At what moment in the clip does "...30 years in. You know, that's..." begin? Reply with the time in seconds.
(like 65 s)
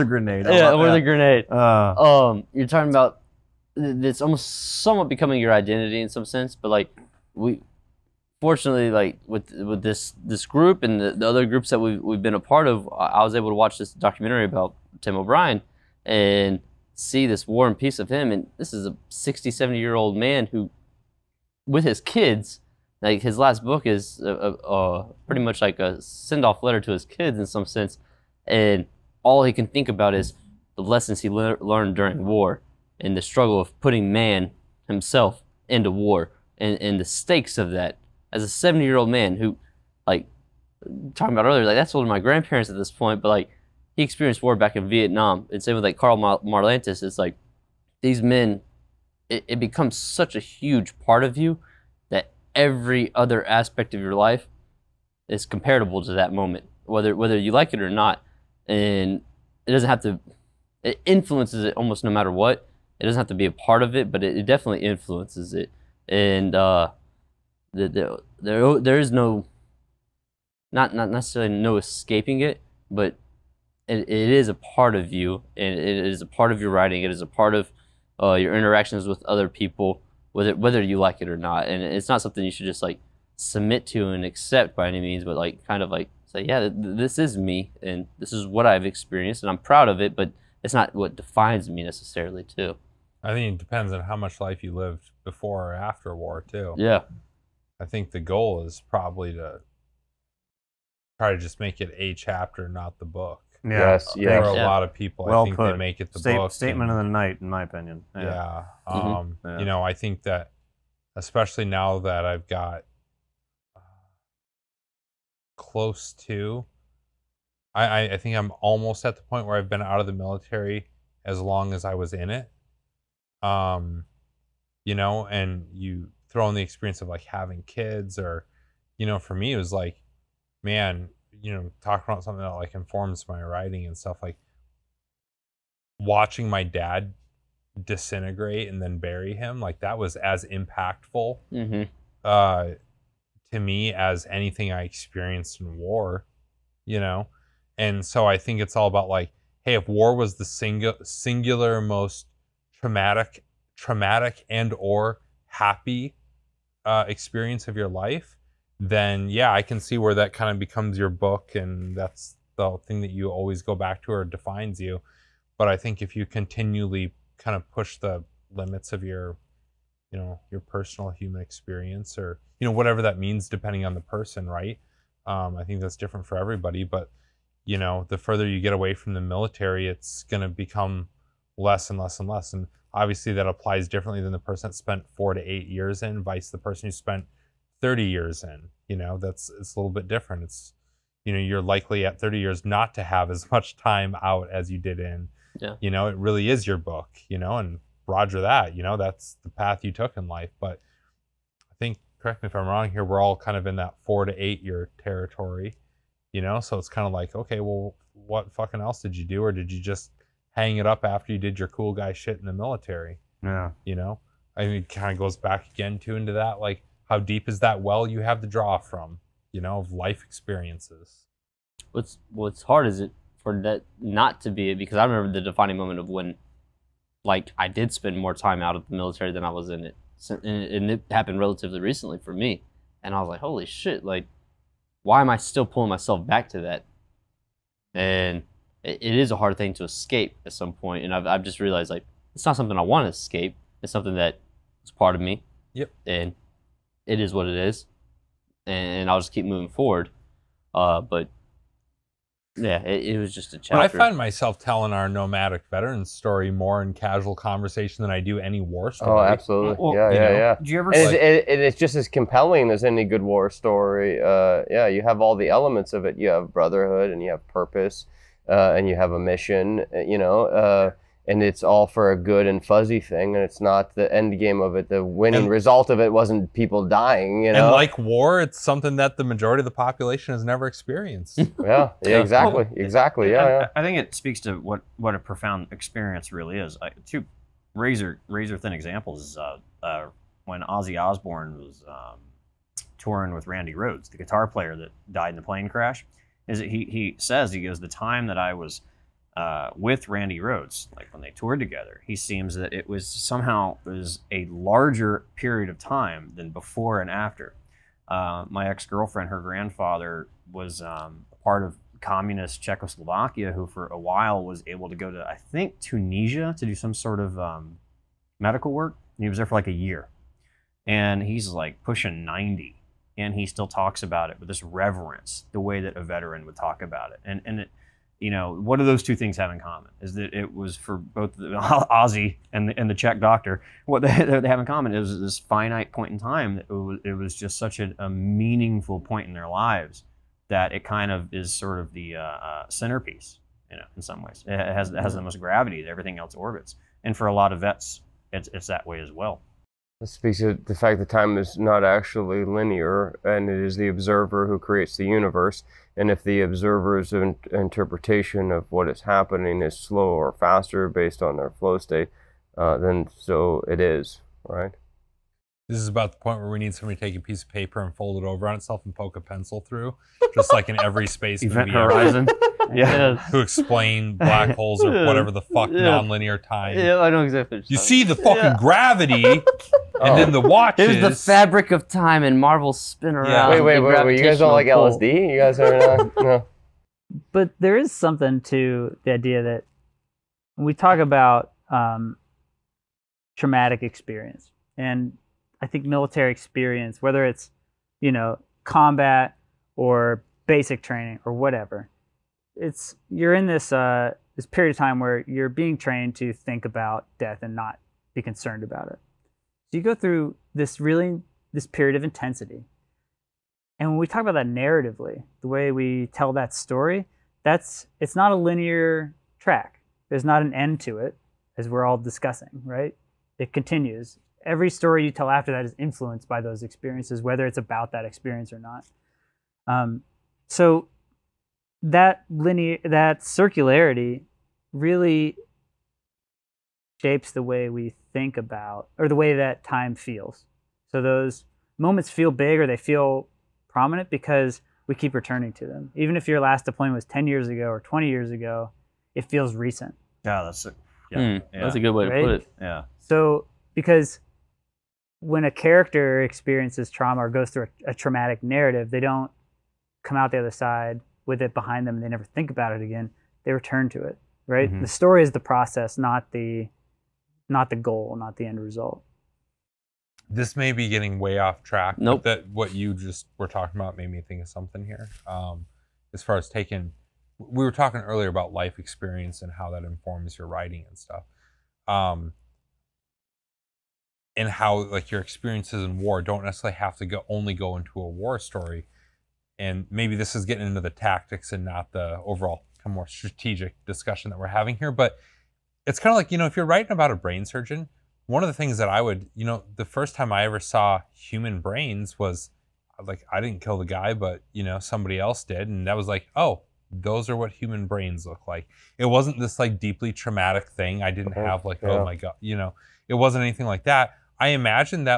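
187 s.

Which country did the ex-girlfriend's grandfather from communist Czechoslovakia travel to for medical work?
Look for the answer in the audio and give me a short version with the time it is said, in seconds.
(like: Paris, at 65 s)
Tunisia, at 315 s.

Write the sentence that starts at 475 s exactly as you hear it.
Um, as far as taking, we were talking earlier about life experience and how that informs your writing and stuff.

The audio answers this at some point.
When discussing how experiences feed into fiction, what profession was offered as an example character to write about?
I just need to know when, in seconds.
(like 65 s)
497 s.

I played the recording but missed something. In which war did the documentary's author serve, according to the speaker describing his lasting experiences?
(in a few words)
Vietnam.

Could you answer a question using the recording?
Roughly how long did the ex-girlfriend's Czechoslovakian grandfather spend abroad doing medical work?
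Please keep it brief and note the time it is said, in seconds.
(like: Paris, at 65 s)
a year, at 319 s.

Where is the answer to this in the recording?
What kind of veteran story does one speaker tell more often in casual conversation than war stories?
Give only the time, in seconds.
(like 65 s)
255 s.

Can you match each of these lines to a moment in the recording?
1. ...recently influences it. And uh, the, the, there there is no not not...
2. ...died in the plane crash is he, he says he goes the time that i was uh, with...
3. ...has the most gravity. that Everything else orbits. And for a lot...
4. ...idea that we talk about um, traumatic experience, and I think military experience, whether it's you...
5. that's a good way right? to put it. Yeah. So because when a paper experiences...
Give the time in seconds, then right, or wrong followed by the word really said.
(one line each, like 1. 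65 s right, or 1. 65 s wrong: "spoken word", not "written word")
1. 64 s wrong: "definitely", not "recently"
2. 295 s right
3. 344 s right
4. 389 s right
5. 451 s wrong: "character", not "paper".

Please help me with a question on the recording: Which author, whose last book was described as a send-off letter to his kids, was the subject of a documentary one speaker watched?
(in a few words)
Tim O'Brien.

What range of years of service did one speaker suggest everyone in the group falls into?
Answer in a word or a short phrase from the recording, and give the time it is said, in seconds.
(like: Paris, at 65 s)
4 to 8 years, at 204 s.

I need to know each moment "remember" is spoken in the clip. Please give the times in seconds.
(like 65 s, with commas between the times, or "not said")
225 s.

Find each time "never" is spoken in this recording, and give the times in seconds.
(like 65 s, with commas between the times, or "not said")
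280 s, 462 s.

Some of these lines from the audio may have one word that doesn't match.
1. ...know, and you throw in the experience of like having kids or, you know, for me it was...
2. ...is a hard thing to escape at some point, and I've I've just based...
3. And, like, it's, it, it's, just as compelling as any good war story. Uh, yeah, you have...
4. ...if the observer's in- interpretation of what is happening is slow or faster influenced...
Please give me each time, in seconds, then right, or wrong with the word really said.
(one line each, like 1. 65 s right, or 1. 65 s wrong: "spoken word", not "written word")
1. 124 s right
2. 239 s wrong: "realized", not "based"
3. 260 s right
4. 356 s wrong: "based", not "influenced".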